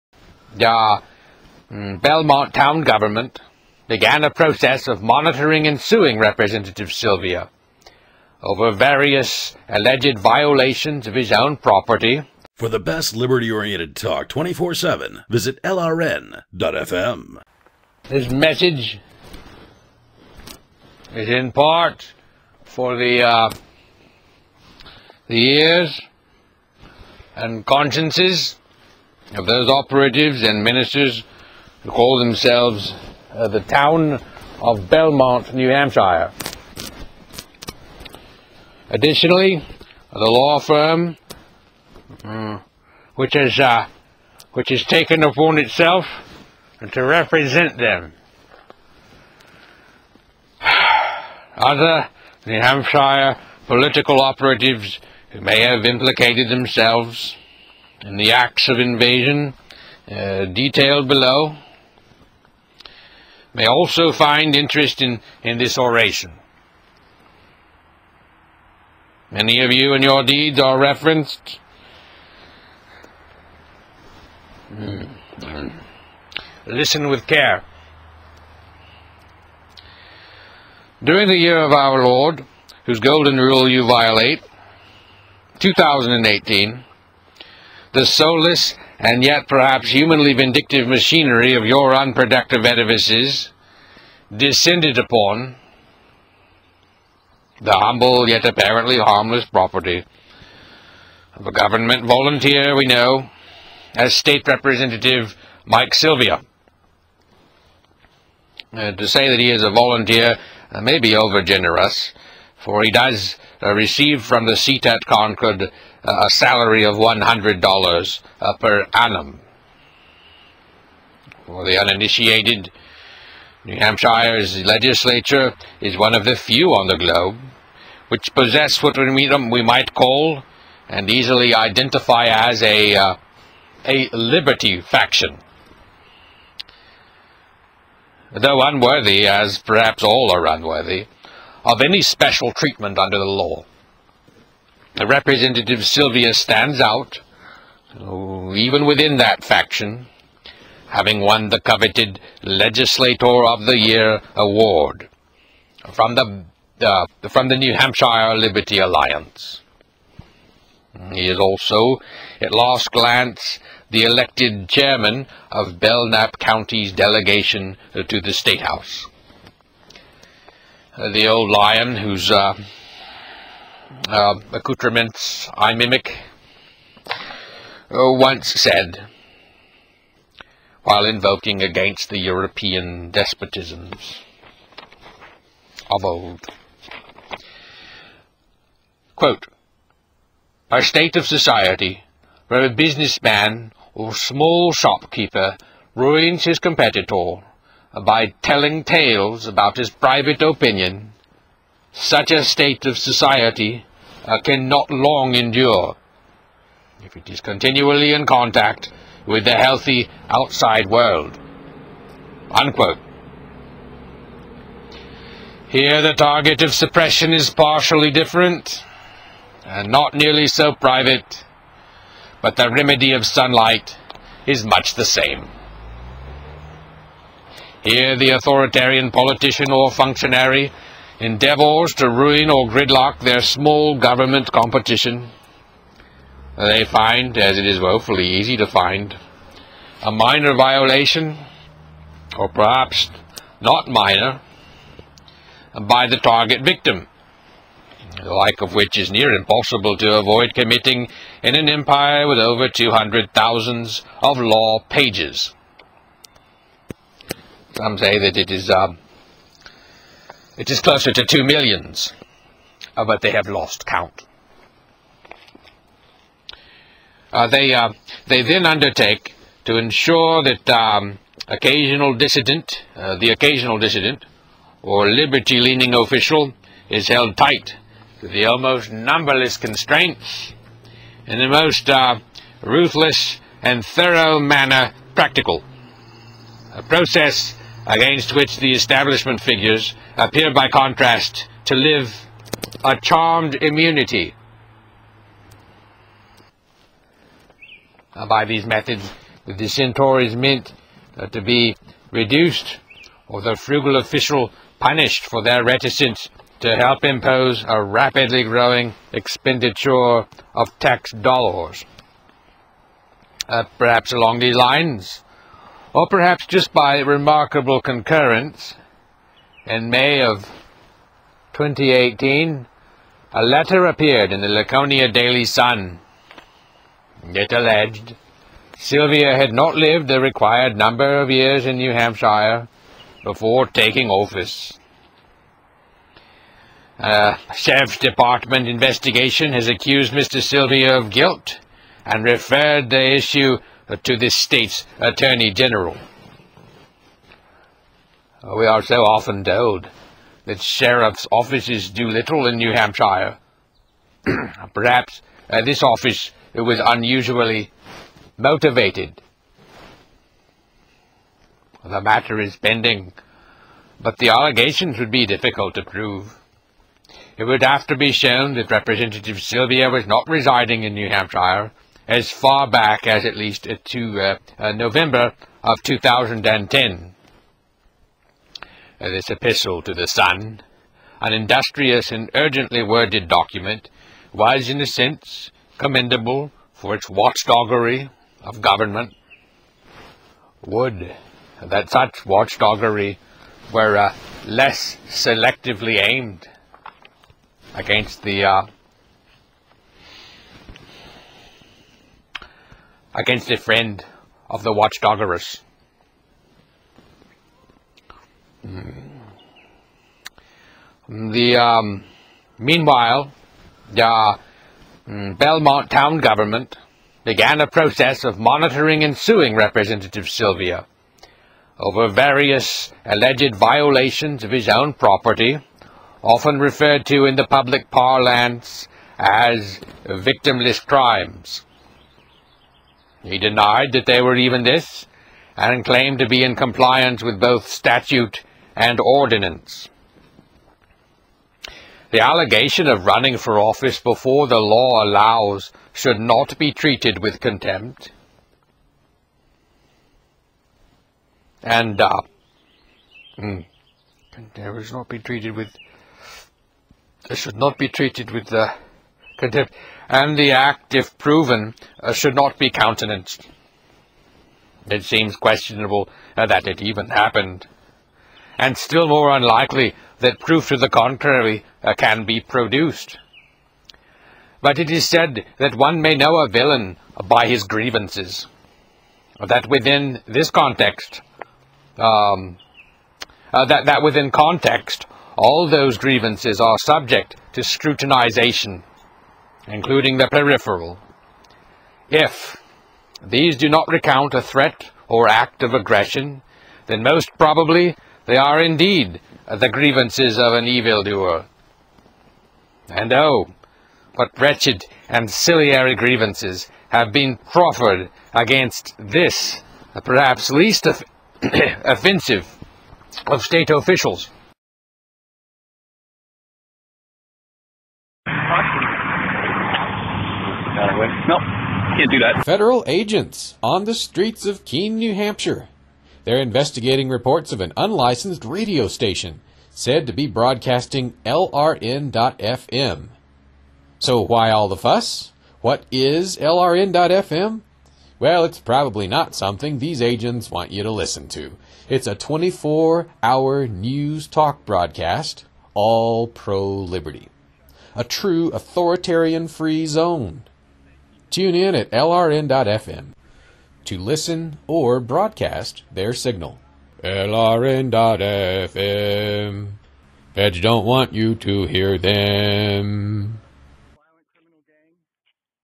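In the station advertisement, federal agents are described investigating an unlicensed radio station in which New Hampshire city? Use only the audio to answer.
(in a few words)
Keene.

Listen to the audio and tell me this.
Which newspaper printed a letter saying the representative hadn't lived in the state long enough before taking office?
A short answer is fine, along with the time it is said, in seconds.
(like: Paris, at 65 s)
Laconia Daily Sun, at 324 s.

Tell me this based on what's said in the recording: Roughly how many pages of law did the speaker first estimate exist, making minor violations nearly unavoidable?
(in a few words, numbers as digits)
200,000.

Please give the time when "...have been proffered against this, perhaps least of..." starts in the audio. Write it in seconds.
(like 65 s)
506 s.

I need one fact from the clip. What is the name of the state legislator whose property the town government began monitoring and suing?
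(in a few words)
Mike Sylvia.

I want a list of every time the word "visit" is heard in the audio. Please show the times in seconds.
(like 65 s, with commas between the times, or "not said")
15 s.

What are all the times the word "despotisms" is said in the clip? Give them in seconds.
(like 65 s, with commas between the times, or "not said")
183 s.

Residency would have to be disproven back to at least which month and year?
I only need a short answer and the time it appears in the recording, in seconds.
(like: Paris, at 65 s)
November 2010, at 374 s.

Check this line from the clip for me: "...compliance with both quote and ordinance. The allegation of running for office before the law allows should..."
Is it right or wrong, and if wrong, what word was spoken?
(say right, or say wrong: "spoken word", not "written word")
wrong: "statute", not "quote".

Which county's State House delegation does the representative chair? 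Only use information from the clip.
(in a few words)
Belknap County.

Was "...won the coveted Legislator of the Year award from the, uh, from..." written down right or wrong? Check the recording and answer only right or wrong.
right.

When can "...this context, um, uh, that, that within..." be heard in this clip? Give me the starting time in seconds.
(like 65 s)
480 s.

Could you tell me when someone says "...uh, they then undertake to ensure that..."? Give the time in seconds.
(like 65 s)
267 s.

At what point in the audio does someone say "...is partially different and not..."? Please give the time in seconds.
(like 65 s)
217 s.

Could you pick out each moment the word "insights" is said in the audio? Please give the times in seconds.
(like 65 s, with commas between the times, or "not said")
not said.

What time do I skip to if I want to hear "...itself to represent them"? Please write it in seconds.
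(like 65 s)
45 s.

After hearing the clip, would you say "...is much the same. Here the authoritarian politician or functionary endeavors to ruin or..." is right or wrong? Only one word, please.
right.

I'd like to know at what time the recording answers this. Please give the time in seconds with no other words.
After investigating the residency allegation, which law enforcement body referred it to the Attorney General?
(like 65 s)
337 s.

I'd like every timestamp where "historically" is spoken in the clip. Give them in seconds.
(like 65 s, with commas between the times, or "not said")
not said.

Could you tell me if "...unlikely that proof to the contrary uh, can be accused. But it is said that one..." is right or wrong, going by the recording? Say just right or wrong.
wrong.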